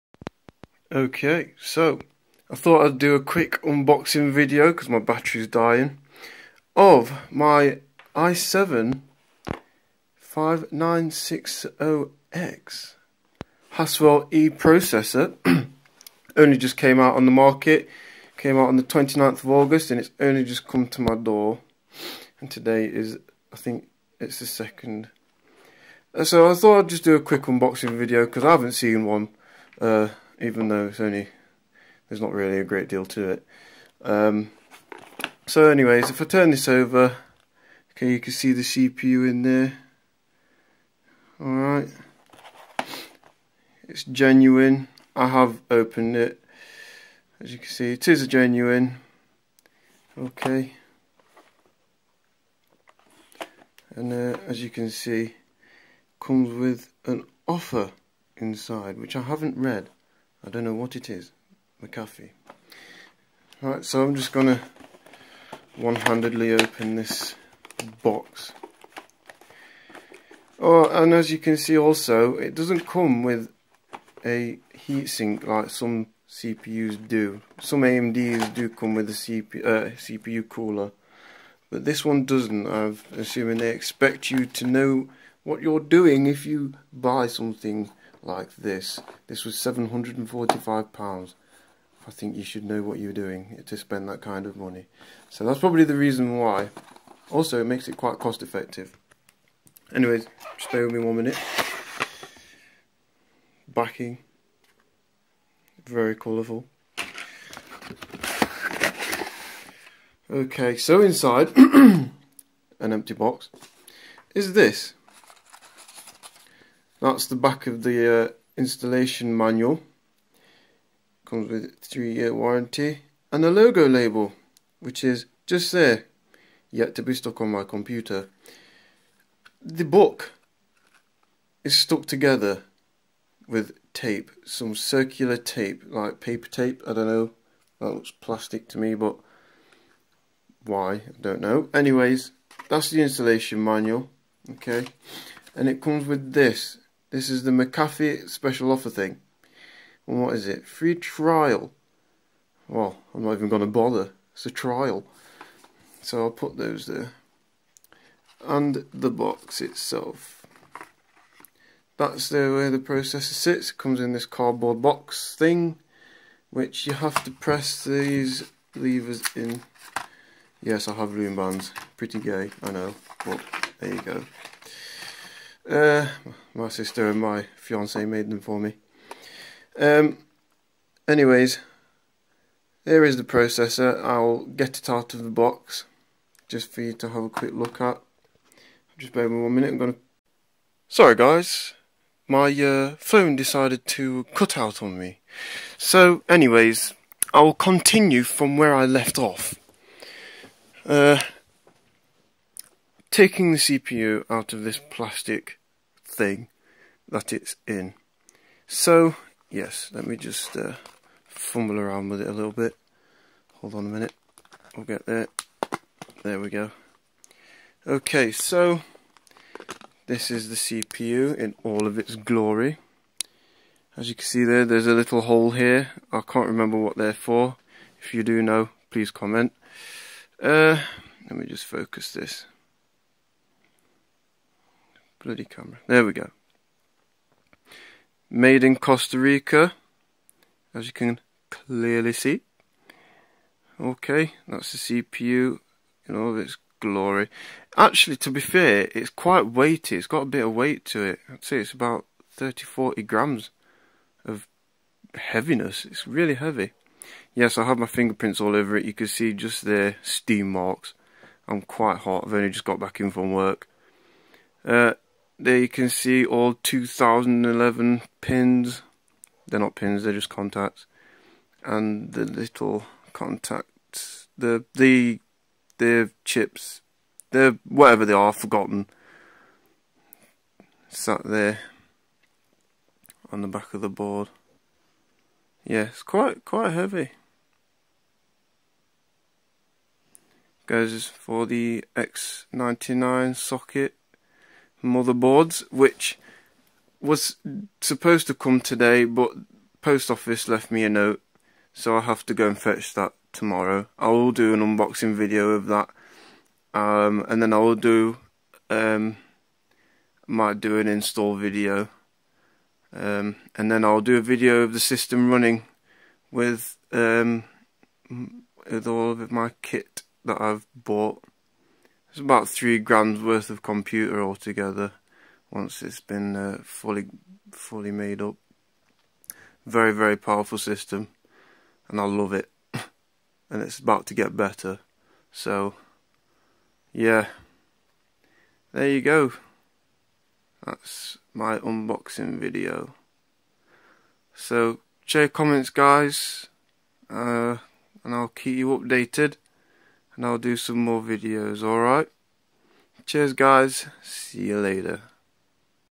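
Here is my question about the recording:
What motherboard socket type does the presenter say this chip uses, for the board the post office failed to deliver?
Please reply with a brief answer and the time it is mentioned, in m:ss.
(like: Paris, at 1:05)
X99, at 4:51.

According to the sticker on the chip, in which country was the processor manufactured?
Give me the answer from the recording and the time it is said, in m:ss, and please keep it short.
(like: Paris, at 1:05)
Costa Rica, at 3:58.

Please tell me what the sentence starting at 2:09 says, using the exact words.
The book is stuck together with tape, some circular tape, like paper tape.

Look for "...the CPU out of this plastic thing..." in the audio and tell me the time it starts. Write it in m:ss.
3:23.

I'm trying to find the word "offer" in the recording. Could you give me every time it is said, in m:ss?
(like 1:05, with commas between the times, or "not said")
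0:57, 2:28.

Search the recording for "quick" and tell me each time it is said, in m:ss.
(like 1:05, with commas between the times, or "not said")
0:03, 0:27, 3:07.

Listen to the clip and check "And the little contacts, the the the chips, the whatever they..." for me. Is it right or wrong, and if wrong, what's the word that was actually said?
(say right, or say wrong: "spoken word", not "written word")
right.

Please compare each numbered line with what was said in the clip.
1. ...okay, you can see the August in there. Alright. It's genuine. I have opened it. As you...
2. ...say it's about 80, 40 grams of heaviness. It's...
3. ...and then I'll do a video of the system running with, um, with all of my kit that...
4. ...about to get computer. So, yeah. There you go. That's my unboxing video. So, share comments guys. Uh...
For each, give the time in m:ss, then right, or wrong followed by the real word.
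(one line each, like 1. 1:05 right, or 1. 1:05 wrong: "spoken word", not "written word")
1. 0:37 wrong: "CPU", not "August"
2. 4:11 wrong: "30", not "80"
3. 5:13 right
4. 5:33 wrong: "better", not "computer".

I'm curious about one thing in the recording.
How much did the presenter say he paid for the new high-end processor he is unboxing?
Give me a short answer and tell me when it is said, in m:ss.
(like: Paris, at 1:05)
£745, at 1:29.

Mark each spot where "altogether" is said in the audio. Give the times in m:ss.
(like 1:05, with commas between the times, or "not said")
5:24.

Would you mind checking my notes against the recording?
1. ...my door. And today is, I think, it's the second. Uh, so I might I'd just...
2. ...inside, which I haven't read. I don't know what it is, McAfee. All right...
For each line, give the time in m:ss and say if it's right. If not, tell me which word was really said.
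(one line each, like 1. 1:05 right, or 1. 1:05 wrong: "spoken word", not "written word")
1. 0:21 wrong: "thought", not "might"
2. 0:58 right.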